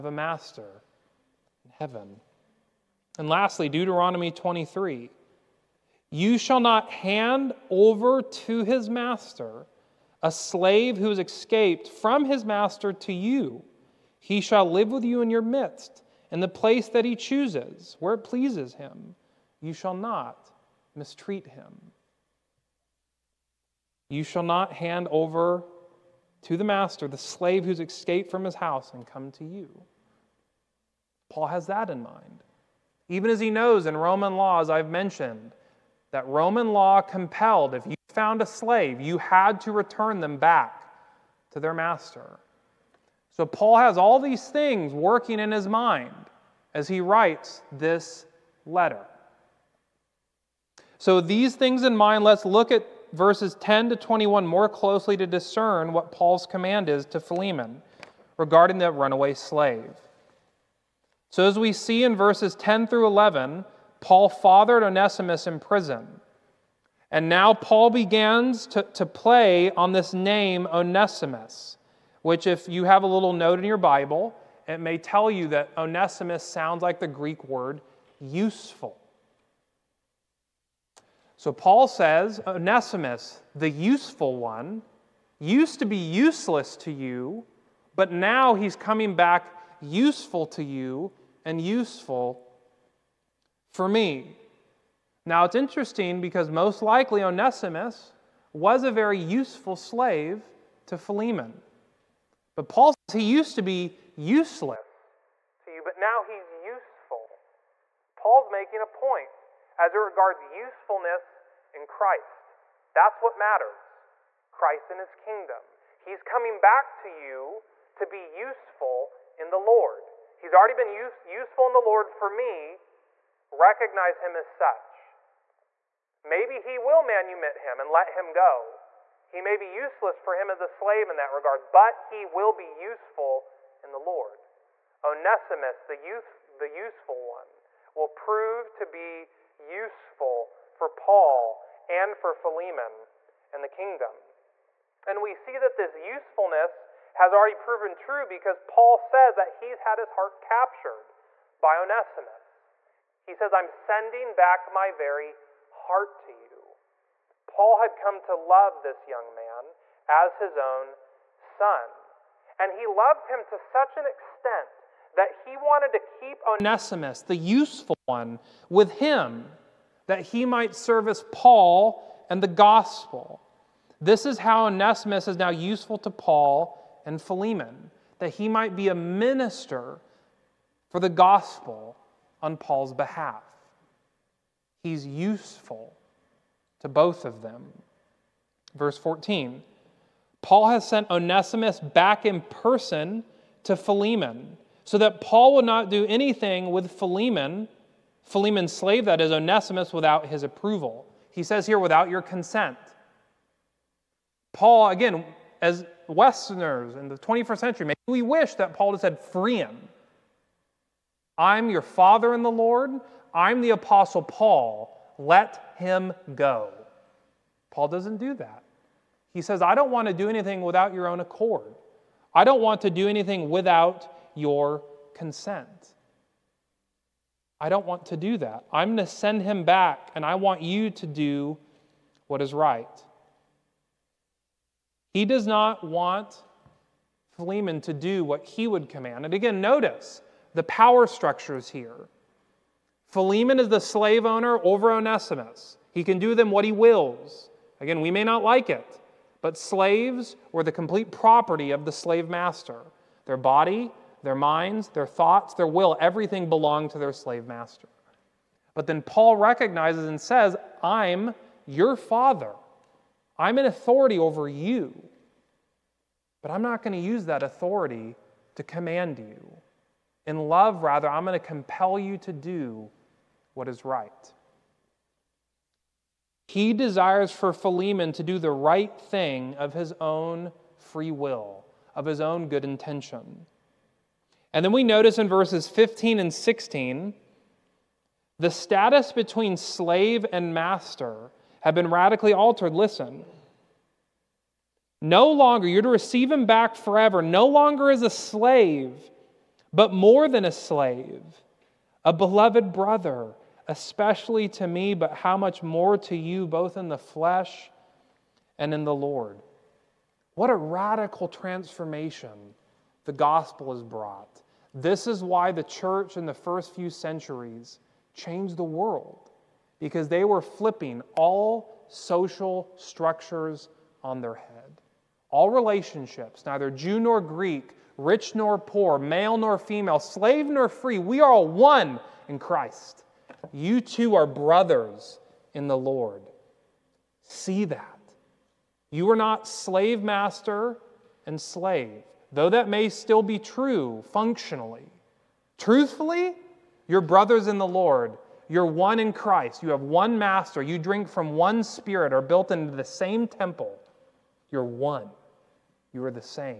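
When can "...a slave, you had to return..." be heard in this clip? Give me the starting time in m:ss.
0:38.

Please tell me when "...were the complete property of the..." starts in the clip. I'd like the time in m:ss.
4:10.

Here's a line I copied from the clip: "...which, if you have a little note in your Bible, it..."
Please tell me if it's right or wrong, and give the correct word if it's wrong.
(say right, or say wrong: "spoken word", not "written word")
right.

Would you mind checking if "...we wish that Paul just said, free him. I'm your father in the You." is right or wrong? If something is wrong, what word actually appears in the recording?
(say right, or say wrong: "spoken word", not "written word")
wrong: "Lord", not "You".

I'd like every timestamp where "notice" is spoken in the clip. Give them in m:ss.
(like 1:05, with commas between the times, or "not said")
3:59, 4:44.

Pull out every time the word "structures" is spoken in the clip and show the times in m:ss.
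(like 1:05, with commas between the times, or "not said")
4:01, 5:22.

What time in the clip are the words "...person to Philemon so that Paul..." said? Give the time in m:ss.
3:12.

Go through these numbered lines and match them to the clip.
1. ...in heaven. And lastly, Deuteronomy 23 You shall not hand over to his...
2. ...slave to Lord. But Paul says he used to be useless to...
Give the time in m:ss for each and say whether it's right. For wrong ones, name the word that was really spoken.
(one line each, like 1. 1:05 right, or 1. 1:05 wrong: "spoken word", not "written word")
1. 0:01 right
2. 1:39 wrong: "Philemon", not "Lord".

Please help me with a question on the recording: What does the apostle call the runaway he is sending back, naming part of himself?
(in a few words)
My very heart.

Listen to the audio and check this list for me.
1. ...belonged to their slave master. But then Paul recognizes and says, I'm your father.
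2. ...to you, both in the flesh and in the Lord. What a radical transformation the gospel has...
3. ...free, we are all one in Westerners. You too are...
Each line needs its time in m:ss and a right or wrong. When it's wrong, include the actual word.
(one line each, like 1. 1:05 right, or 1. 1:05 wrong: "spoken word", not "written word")
1. 4:16 right
2. 5:05 right
3. 5:30 wrong: "Christ", not "Westerners".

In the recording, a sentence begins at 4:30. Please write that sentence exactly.
In love, rather, I'm going to compel you to do what is right.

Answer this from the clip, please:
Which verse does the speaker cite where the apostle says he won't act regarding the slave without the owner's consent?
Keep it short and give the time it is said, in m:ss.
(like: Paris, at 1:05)
Verse 14, at 3:08.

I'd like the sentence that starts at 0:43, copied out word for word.
So Paul has all these things working in his mind as he writes this letter.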